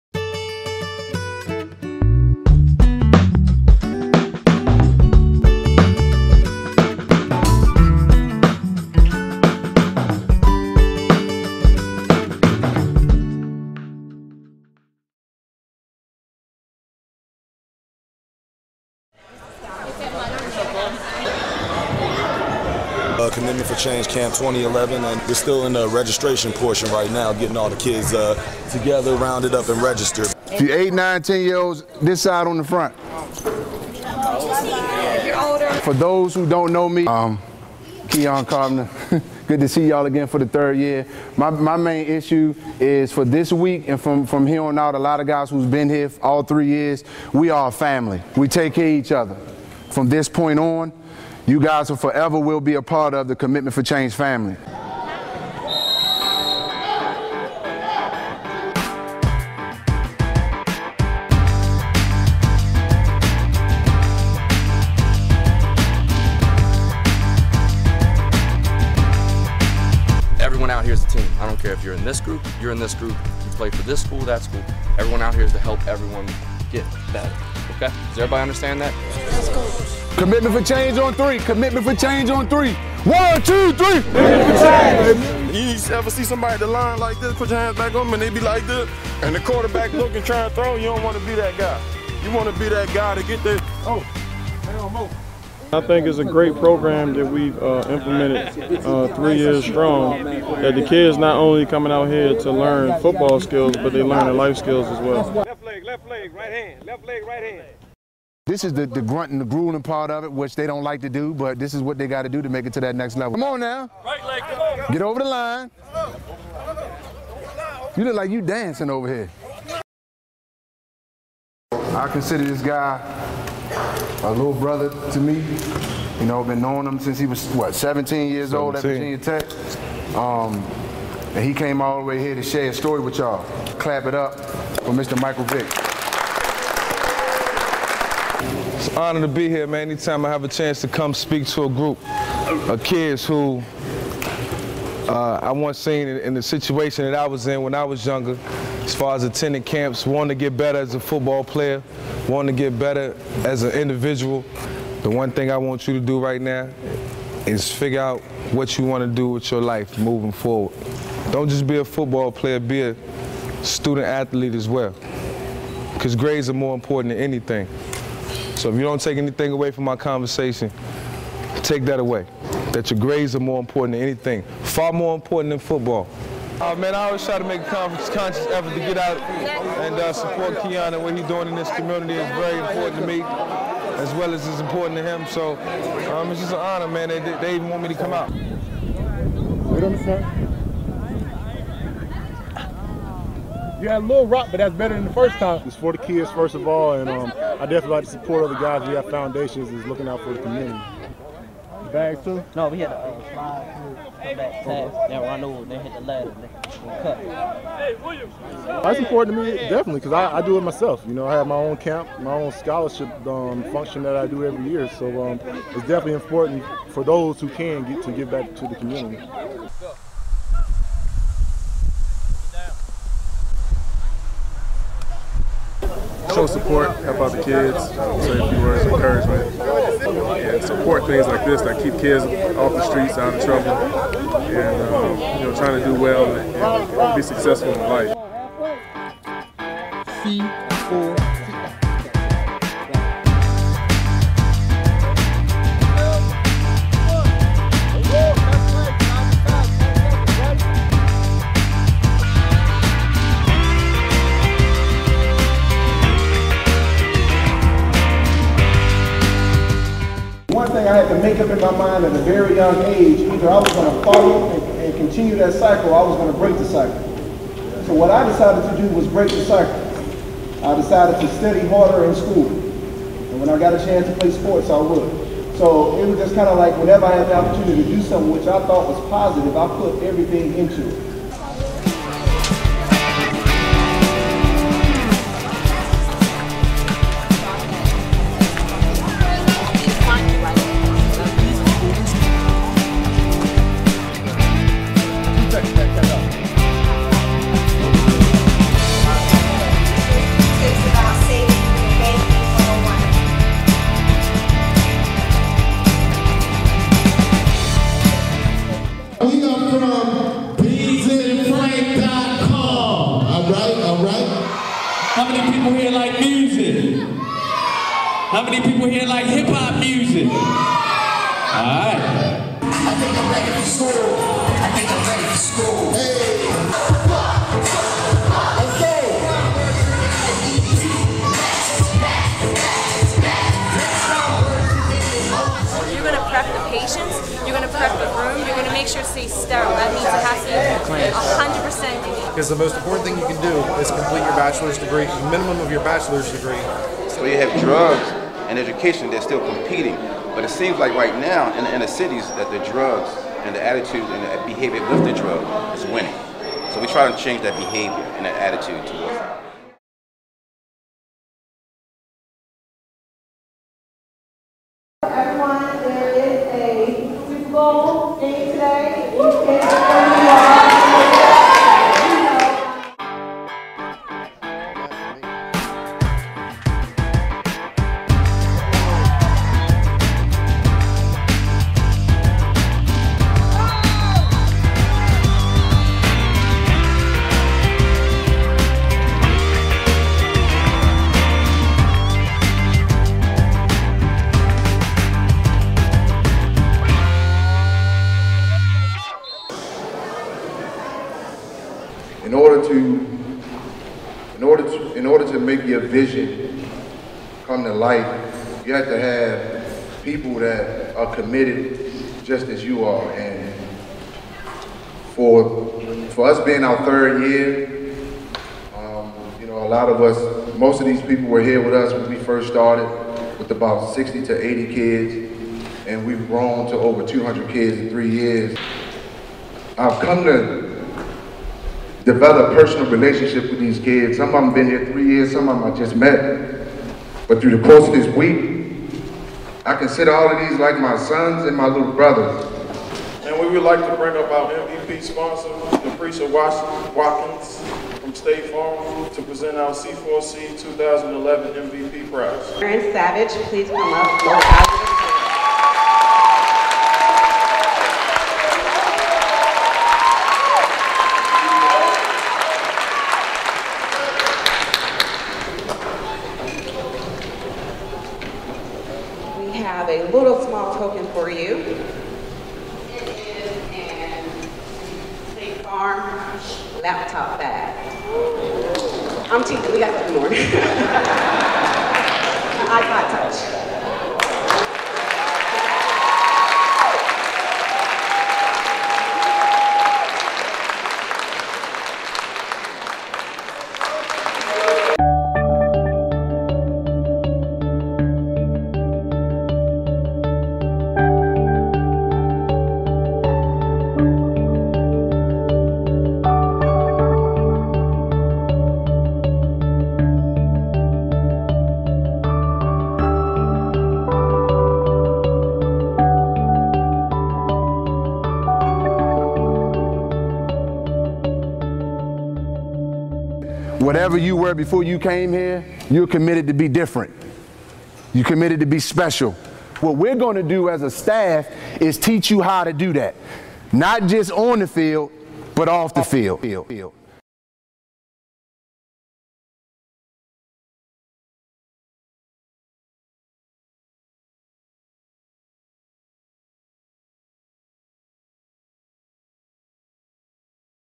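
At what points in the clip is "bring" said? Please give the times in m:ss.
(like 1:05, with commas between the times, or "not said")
7:23.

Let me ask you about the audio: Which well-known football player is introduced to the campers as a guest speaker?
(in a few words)
Michael Vick.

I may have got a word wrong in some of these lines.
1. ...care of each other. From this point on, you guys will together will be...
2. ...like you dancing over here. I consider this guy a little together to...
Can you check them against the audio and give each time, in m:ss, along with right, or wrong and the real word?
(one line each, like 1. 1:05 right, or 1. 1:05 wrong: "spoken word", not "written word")
1. 0:48 wrong: "forever", not "together"
2. 1:58 wrong: "brother", not "together".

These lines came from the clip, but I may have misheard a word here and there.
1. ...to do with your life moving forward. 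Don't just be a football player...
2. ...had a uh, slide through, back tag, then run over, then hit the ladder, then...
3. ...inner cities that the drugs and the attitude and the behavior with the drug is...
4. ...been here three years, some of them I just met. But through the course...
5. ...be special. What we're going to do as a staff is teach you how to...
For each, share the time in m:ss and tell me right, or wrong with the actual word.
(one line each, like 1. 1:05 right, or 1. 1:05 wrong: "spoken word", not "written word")
1. 2:39 right
2. 3:22 right
3. 5:51 right
4. 7:14 right
5. 8:48 right.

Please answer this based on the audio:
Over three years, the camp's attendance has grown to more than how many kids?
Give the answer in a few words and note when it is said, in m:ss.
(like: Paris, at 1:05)
200, at 7:07.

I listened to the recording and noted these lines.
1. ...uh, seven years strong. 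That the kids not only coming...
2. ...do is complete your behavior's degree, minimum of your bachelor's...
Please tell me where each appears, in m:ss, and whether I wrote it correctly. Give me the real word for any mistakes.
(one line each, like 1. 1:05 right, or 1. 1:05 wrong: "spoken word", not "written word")
1. 1:38 wrong: "three", not "seven"
2. 5:43 wrong: "bachelor", not "behavior".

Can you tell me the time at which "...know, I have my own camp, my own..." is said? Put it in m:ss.
3:31.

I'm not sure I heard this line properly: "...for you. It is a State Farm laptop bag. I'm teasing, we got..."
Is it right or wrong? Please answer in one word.
right.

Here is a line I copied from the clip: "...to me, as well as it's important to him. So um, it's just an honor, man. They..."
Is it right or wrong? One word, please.
right.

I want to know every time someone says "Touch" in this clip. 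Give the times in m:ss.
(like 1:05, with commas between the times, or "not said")
8:03.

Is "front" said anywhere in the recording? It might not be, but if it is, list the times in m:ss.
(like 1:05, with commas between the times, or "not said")
0:32.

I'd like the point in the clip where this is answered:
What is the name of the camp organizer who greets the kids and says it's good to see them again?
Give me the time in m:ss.
0:38.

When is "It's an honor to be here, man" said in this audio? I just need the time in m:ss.
2:18.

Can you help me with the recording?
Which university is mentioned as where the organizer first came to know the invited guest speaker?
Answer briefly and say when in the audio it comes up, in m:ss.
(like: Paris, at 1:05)
Virginia Tech, at 2:08.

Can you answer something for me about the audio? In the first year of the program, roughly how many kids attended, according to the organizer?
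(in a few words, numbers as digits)
60 to 80.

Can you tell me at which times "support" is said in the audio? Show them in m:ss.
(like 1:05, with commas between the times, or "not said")
3:00, 3:18, 3:46, 3:50.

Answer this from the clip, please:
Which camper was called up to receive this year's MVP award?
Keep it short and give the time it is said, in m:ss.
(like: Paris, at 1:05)
Aaron Savage, at 7:32.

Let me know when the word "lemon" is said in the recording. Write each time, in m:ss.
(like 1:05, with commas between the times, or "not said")
not said.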